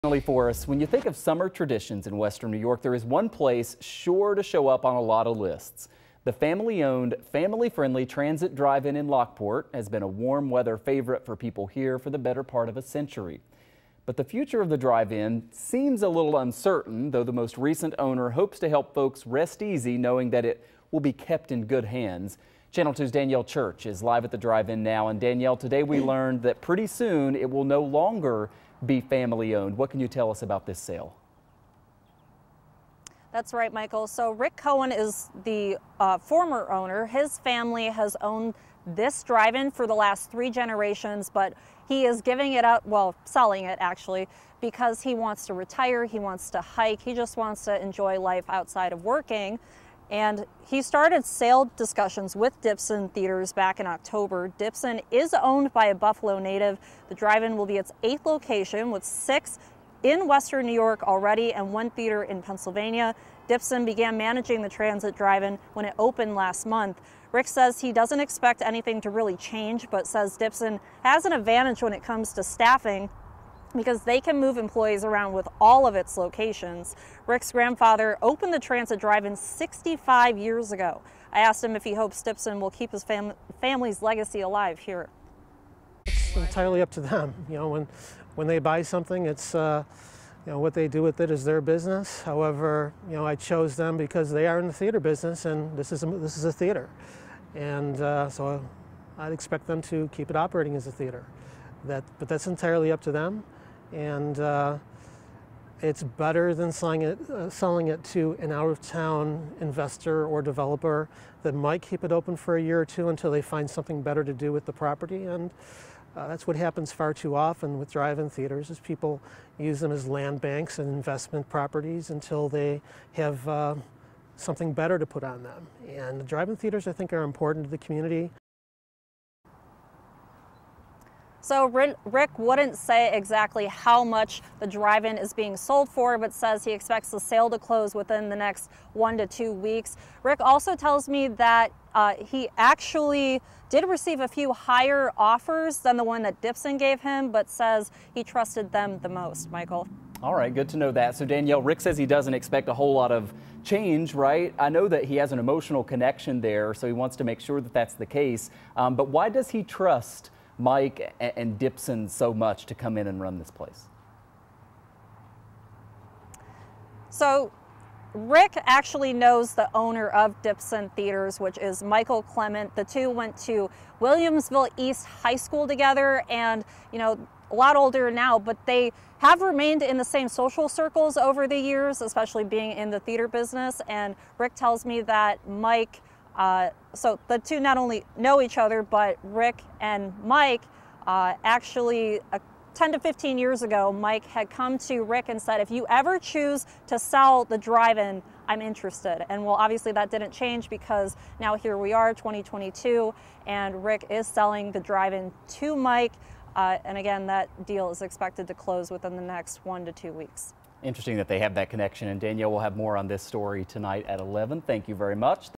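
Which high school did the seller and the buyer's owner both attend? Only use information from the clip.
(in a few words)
Williamsville East High School.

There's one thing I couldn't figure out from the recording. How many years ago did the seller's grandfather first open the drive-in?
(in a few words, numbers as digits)
65.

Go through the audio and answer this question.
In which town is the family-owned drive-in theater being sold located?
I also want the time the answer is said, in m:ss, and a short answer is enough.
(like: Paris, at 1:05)
Lockport, at 0:09.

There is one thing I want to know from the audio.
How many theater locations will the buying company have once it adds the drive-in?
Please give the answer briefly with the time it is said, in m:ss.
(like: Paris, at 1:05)
8, at 0:58.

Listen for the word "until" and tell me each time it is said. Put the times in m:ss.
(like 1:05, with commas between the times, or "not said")
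1:53, 2:02.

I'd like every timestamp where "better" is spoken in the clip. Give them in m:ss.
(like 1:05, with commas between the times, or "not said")
0:12, 1:46, 1:54, 2:04.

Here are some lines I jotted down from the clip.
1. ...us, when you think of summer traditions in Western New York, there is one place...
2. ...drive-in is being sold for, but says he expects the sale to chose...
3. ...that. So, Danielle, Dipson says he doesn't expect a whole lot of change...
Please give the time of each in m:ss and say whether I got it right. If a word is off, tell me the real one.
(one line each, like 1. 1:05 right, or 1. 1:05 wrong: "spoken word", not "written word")
1. 0:00 right
2. 2:14 wrong: "close", not "chose"
3. 2:30 wrong: "Rick", not "Dipson".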